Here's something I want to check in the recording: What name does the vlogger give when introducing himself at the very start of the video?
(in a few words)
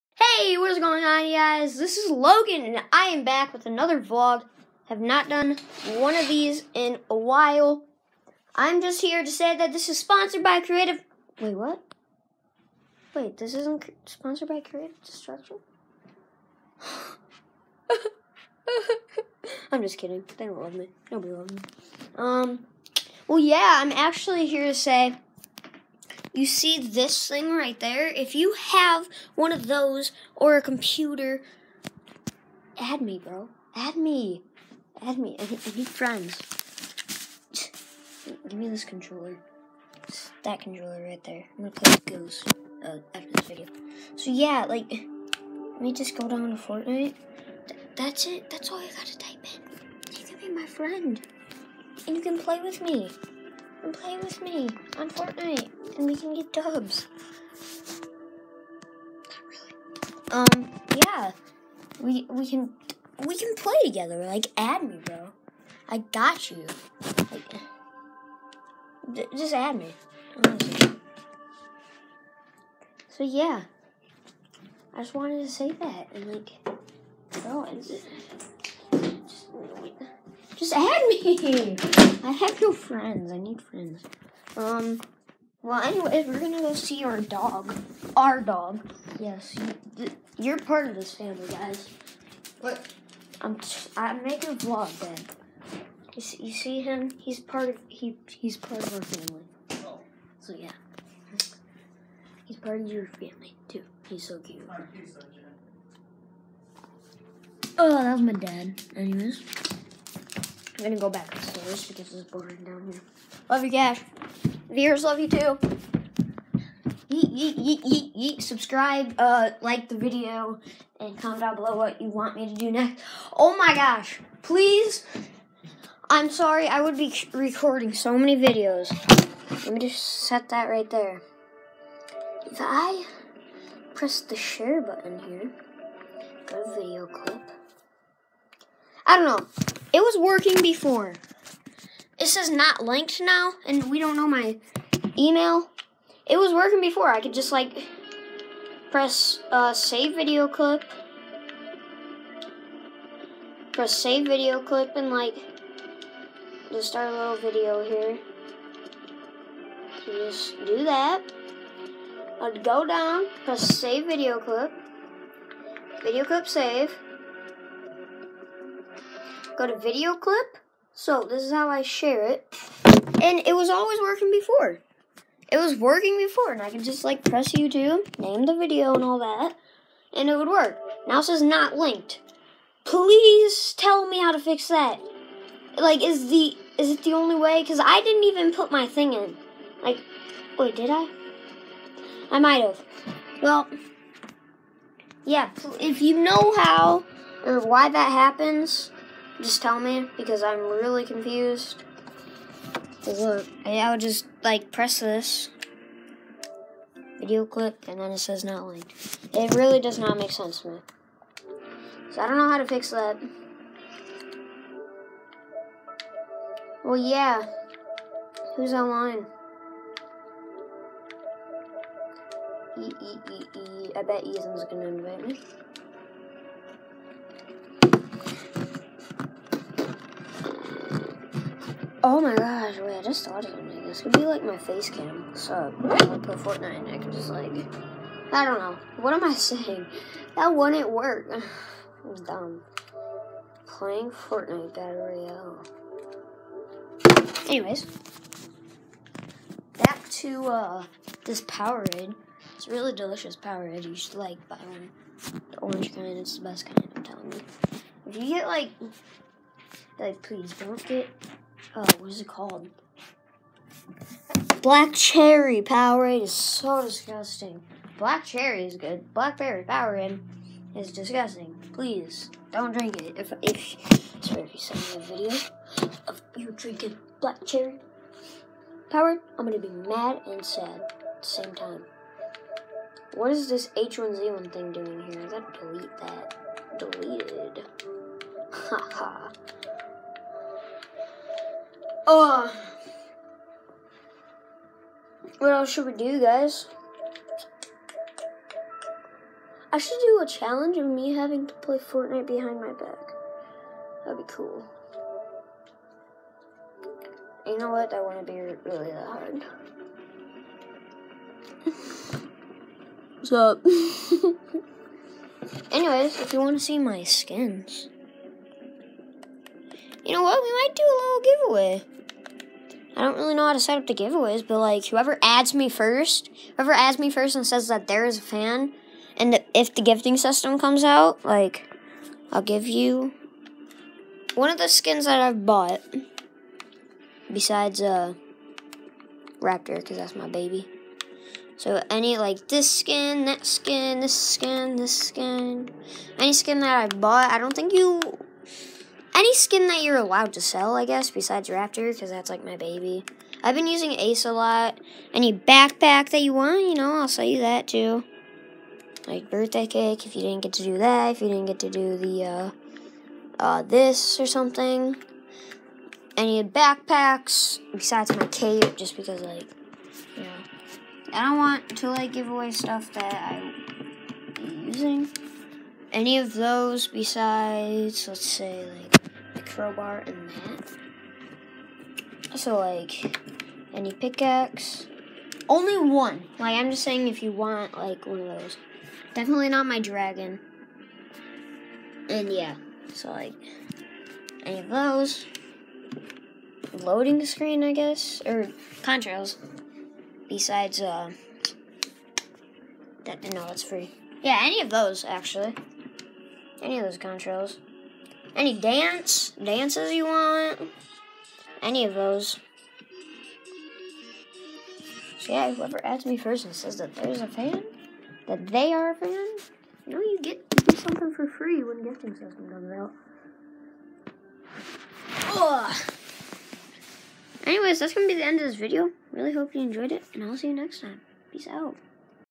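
Logan.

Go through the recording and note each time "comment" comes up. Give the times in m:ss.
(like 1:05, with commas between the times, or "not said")
2:01.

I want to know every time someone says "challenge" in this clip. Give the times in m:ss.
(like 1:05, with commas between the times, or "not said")
5:00.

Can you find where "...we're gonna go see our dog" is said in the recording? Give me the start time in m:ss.
1:26.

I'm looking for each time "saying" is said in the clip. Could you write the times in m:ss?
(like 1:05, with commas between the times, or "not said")
3:59, 6:26.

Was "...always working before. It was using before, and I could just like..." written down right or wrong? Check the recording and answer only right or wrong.
wrong.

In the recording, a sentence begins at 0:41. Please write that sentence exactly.
I'm gonna play with Goose uh, after this video.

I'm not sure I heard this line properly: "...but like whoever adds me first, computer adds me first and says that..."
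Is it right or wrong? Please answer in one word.
wrong.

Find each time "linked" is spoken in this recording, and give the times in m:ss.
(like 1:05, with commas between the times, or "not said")
2:22, 3:01, 3:28.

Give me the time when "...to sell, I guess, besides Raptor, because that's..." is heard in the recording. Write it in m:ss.
5:50.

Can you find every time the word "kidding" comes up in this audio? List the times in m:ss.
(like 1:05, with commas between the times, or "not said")
0:19.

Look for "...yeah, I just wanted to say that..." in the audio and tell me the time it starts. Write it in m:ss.
1:13.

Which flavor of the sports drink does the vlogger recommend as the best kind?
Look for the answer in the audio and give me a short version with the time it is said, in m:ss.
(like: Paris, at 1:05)
orange, at 4:15.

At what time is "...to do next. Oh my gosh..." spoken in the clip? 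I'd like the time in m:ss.
2:02.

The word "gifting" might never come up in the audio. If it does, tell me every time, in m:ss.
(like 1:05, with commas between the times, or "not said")
5:29, 7:01.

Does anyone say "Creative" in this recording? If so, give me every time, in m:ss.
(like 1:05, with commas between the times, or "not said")
0:10, 0:14.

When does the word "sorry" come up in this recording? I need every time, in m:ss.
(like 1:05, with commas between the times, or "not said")
2:06, 4:34.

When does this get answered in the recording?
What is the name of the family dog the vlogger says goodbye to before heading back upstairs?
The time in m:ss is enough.
1:53.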